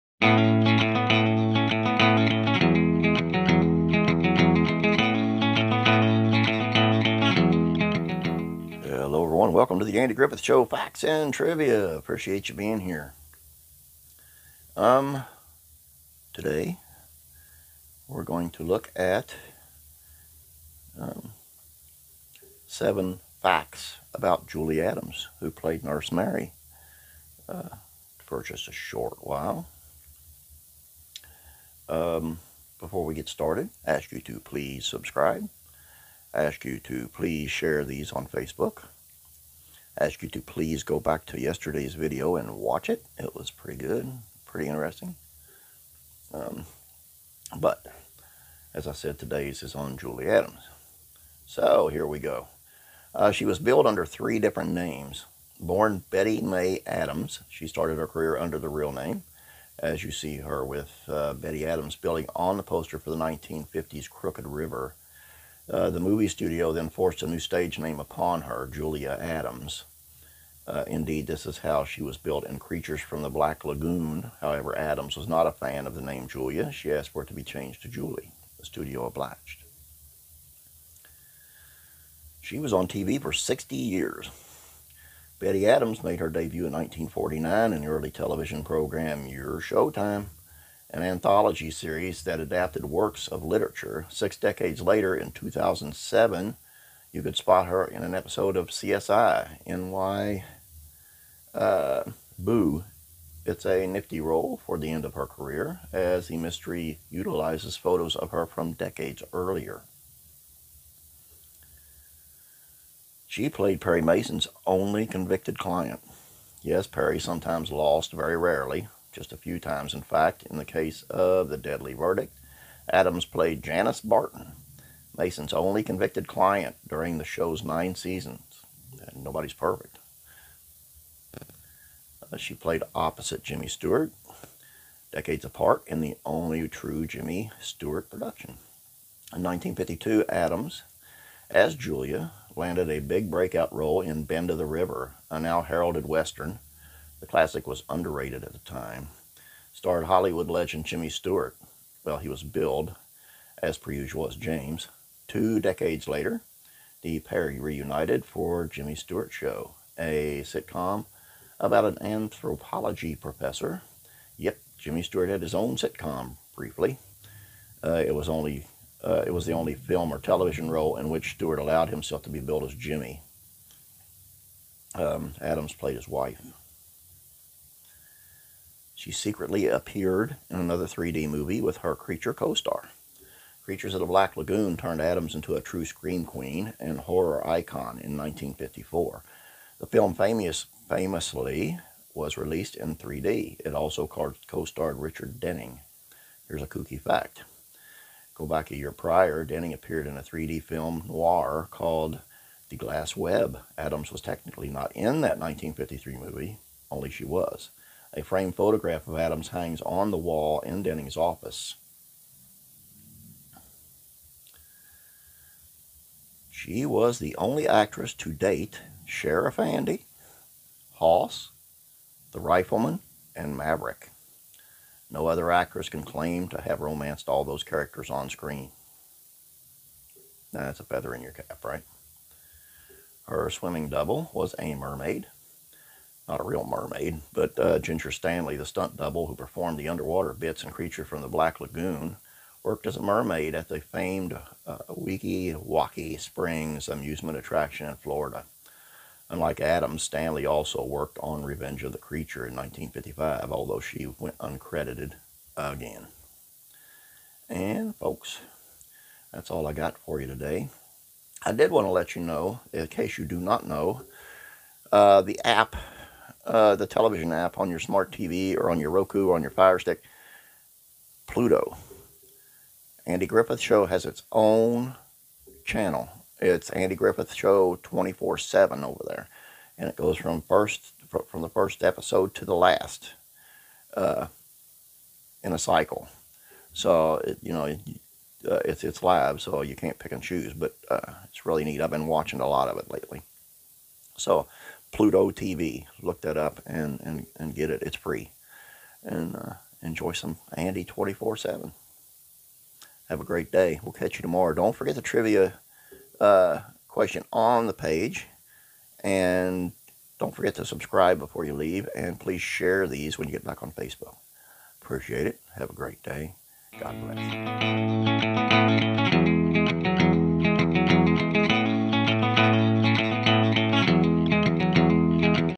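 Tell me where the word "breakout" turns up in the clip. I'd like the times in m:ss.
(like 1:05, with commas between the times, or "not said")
2:23.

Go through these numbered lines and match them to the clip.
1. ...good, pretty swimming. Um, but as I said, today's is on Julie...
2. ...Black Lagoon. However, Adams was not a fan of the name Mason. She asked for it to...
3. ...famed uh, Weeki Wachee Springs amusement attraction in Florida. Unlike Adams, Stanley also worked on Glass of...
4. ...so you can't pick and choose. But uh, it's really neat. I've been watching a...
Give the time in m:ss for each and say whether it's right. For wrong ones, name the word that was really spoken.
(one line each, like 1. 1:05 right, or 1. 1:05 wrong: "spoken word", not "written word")
1. 0:43 wrong: "interesting", not "swimming"
2. 1:13 wrong: "Julia", not "Mason"
3. 4:03 wrong: "Revenge", not "Glass"
4. 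4:49 right.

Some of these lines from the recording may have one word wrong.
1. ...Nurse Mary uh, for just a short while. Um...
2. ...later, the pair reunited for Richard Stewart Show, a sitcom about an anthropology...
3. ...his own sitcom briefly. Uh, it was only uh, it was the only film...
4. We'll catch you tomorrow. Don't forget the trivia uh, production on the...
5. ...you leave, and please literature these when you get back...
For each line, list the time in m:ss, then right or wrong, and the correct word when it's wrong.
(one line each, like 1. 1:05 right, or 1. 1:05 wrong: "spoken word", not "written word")
1. 0:25 right
2. 2:36 wrong: "Jimmy", not "Richard"
3. 2:45 right
4. 5:03 wrong: "question", not "production"
5. 5:11 wrong: "share", not "literature".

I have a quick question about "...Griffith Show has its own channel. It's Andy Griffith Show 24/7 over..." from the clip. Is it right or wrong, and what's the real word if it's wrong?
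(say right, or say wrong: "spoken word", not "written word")
right.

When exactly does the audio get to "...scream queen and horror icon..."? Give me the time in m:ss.
3:05.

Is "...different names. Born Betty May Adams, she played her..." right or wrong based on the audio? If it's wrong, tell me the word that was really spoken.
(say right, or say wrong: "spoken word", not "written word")
wrong: "started", not "played".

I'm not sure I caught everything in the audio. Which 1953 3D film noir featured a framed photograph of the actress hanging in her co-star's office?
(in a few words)
The Glass Web.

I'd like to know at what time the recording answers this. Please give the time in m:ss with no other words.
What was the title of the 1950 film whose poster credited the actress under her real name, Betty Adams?
1:04.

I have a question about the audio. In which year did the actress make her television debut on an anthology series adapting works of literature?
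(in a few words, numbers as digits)
1949.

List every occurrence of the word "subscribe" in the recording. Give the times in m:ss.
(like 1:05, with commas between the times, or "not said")
0:34, 5:10.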